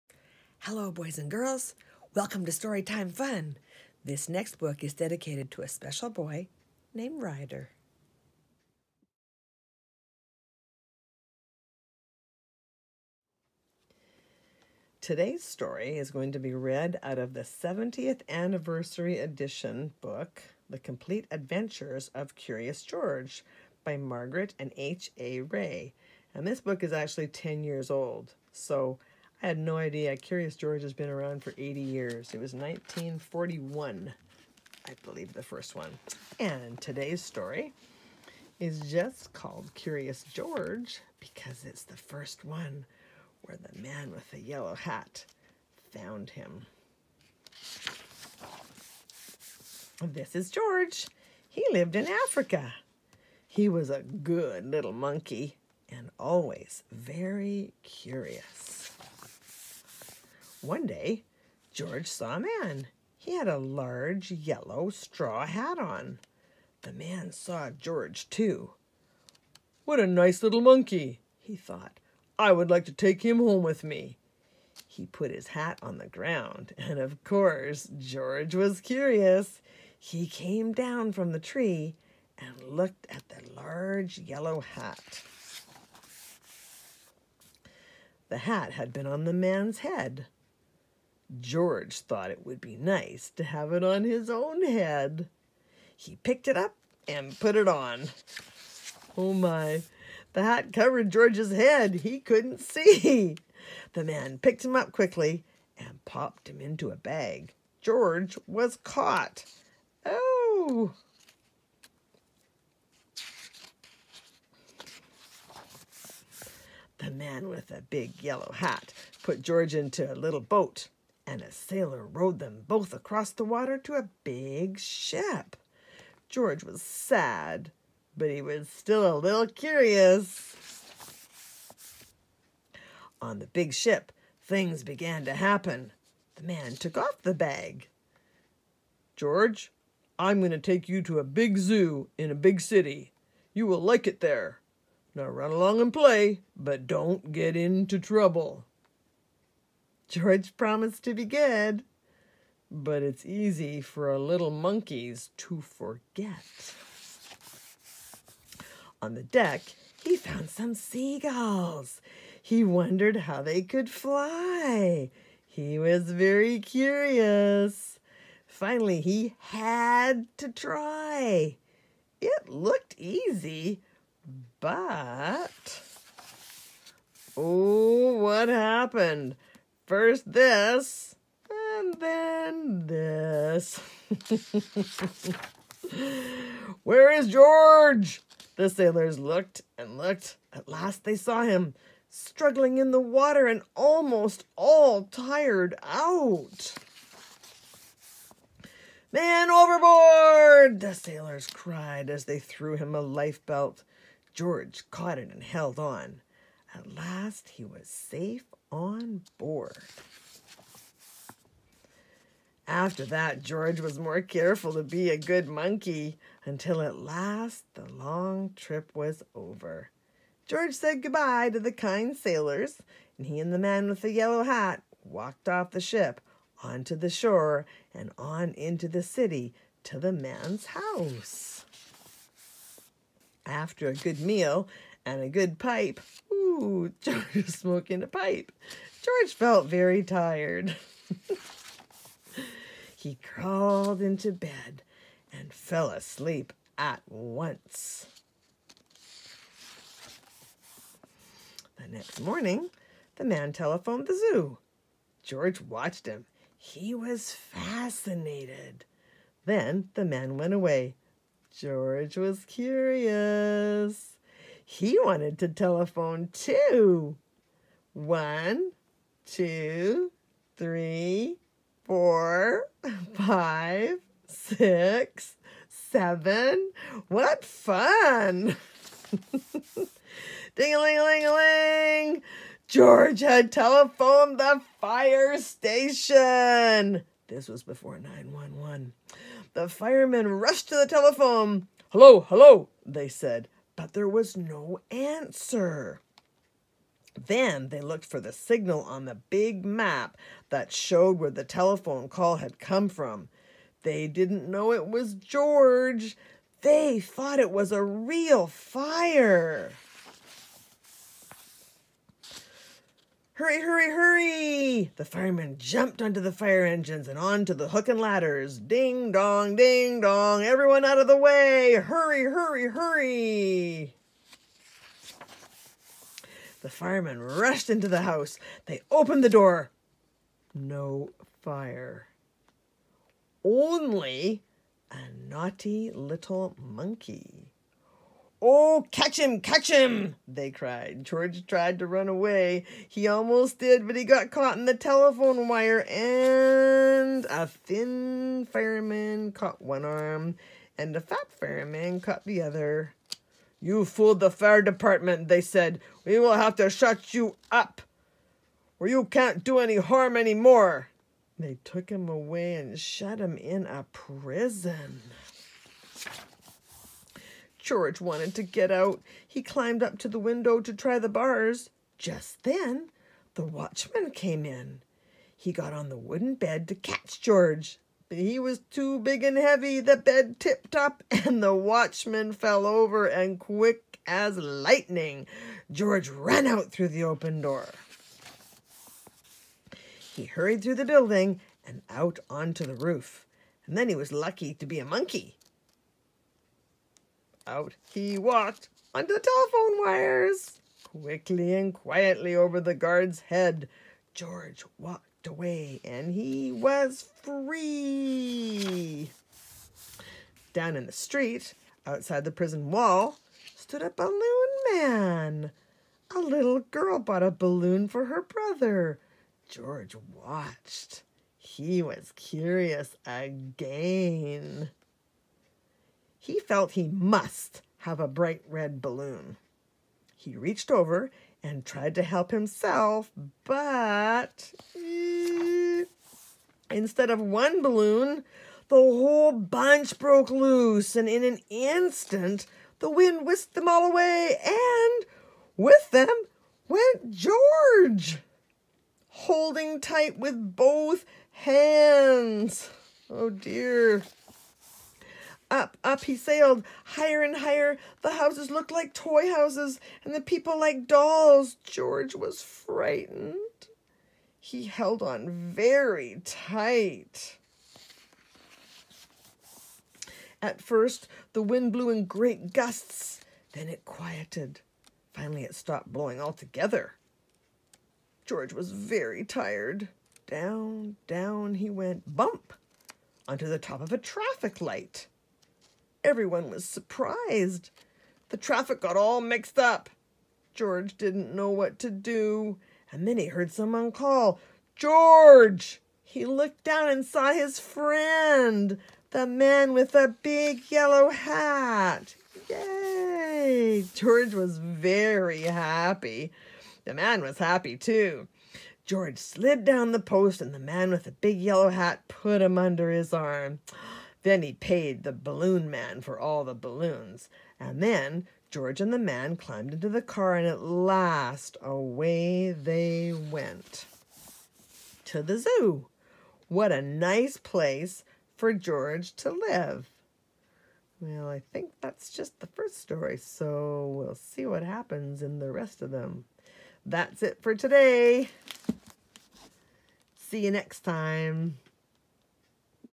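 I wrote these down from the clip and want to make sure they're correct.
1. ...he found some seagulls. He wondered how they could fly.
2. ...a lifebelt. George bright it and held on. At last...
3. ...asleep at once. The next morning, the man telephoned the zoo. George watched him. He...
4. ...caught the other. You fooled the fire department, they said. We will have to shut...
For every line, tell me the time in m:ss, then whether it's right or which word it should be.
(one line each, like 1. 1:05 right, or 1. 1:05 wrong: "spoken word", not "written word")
1. 2:40 right
2. 3:22 wrong: "caught", not "bright"
3. 4:05 right
4. 5:52 right.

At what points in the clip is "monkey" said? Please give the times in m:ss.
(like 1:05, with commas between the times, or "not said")
0:54, 1:10, 2:34, 3:35, 5:36, 6:34.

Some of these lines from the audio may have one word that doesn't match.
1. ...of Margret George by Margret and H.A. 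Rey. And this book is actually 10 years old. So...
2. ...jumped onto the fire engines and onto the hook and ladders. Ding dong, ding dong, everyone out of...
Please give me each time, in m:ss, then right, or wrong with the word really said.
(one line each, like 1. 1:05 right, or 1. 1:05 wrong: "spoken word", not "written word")
1. 0:22 wrong: "Curious", not "Margret"
2. 5:15 right.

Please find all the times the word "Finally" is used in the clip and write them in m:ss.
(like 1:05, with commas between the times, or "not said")
2:48, 7:55.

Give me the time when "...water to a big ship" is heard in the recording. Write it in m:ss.
2:03.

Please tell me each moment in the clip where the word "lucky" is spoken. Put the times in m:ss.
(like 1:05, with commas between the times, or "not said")
6:34.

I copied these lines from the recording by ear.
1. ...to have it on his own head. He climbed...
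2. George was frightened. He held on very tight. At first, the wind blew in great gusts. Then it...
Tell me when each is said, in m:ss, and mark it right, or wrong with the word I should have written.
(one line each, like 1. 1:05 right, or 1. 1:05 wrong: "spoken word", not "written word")
1. 1:33 wrong: "picked", not "climbed"
2. 7:41 right.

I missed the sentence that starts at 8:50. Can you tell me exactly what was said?
Well, I think that's just the first story, so we'll see what happens in the rest of them.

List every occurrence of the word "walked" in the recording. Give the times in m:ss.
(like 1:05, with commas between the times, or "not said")
3:45, 6:38, 6:44.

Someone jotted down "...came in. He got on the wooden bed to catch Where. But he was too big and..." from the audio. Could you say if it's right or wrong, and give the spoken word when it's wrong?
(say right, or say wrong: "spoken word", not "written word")
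wrong: "George", not "Where".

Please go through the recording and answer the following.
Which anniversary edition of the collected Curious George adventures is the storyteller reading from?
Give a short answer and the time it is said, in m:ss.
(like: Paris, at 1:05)
70th, at 0:17.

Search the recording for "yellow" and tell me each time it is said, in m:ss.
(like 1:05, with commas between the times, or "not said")
0:44, 1:04, 1:24, 1:58, 3:44, 8:20, 8:31.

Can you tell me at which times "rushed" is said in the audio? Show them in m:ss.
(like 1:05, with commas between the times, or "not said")
4:50, 5:27.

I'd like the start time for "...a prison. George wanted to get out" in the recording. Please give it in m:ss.
6:03.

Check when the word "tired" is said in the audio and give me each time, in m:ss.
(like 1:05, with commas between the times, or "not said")
3:15, 4:00, 7:59.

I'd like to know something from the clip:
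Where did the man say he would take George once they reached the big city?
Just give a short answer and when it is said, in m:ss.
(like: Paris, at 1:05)
A big zoo, at 2:21.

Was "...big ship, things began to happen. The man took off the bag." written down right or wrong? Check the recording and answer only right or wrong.
right.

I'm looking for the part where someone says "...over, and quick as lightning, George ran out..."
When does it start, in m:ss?
6:22.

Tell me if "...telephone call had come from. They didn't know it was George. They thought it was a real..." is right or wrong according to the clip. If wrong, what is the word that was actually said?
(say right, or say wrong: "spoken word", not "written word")
right.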